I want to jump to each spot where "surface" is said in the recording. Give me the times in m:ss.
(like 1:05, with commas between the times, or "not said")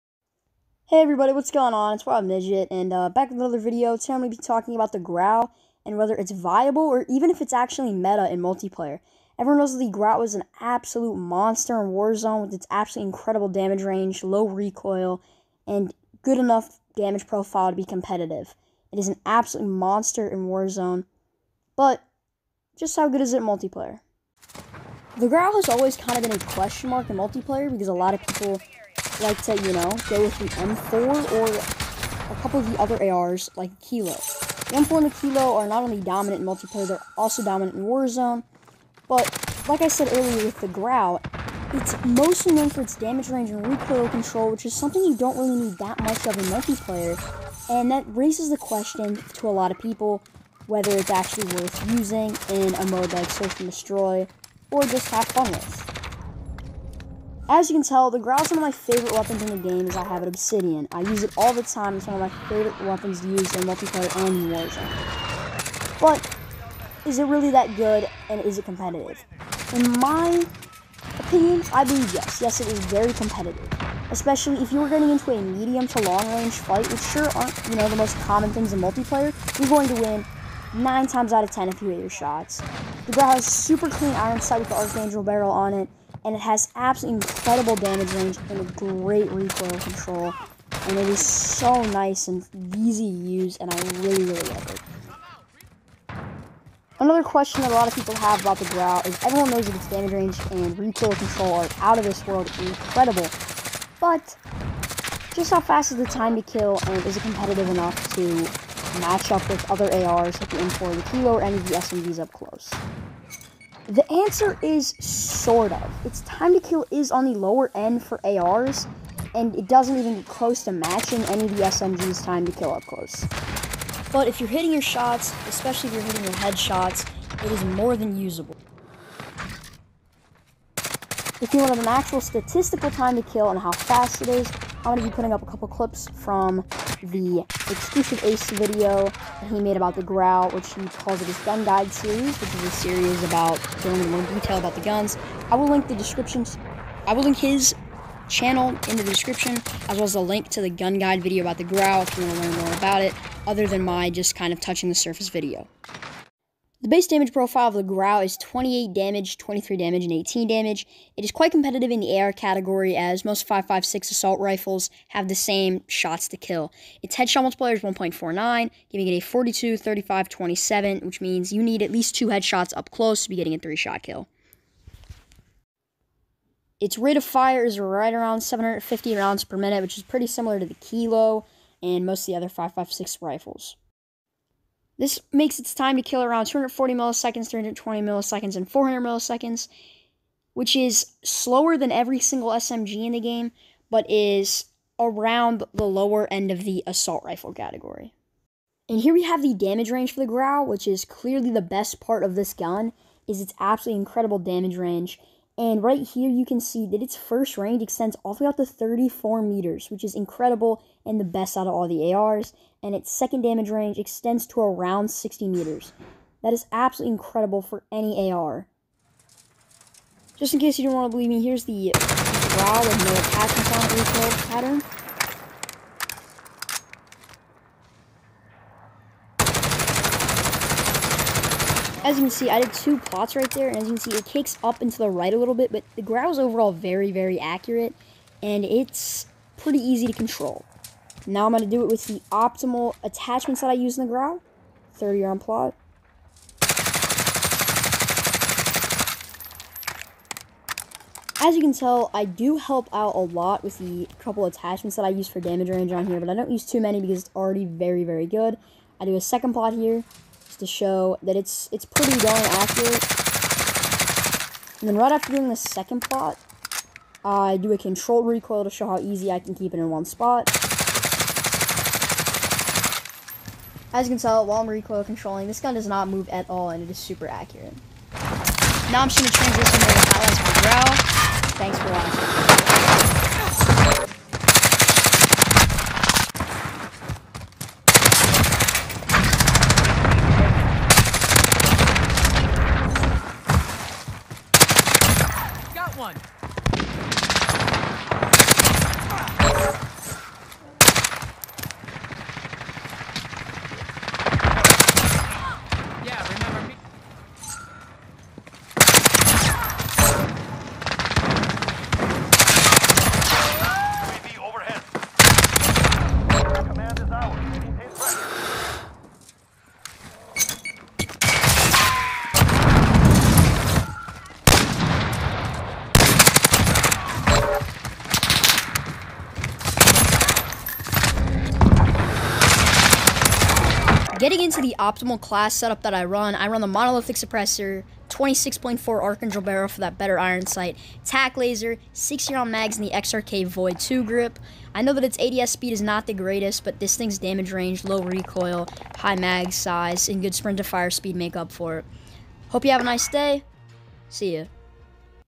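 2:34.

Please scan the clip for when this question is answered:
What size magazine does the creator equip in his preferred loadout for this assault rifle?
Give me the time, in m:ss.
5:41.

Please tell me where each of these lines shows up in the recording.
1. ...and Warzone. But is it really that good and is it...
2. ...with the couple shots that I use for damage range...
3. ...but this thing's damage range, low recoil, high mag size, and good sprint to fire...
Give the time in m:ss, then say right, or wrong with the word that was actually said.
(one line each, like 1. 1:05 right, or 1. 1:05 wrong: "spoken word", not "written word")
1. 1:04 right
2. 4:13 wrong: "attachments", not "shots"
3. 5:46 right.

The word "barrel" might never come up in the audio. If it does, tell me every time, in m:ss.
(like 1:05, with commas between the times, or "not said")
1:25, 5:39.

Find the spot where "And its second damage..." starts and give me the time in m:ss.
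3:32.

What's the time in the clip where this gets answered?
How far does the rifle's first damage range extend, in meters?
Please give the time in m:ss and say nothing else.
3:28.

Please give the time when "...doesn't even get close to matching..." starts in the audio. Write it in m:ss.
1:59.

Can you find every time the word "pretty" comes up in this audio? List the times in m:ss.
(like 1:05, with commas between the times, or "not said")
3:00, 3:59, 4:21.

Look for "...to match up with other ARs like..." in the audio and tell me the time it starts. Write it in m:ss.
1:48.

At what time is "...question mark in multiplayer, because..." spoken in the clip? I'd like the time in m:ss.
0:26.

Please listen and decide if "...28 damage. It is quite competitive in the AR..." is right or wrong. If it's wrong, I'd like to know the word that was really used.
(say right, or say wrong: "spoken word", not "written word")
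wrong: "18", not "28".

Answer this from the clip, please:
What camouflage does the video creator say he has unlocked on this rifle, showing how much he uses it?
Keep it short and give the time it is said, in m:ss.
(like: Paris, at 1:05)
Obsidian, at 1:00.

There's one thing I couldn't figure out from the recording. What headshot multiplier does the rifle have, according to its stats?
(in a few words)
1.49.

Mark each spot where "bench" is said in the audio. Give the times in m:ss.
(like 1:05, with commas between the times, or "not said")
not said.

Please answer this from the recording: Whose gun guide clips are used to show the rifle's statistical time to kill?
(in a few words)
XclusiveAce.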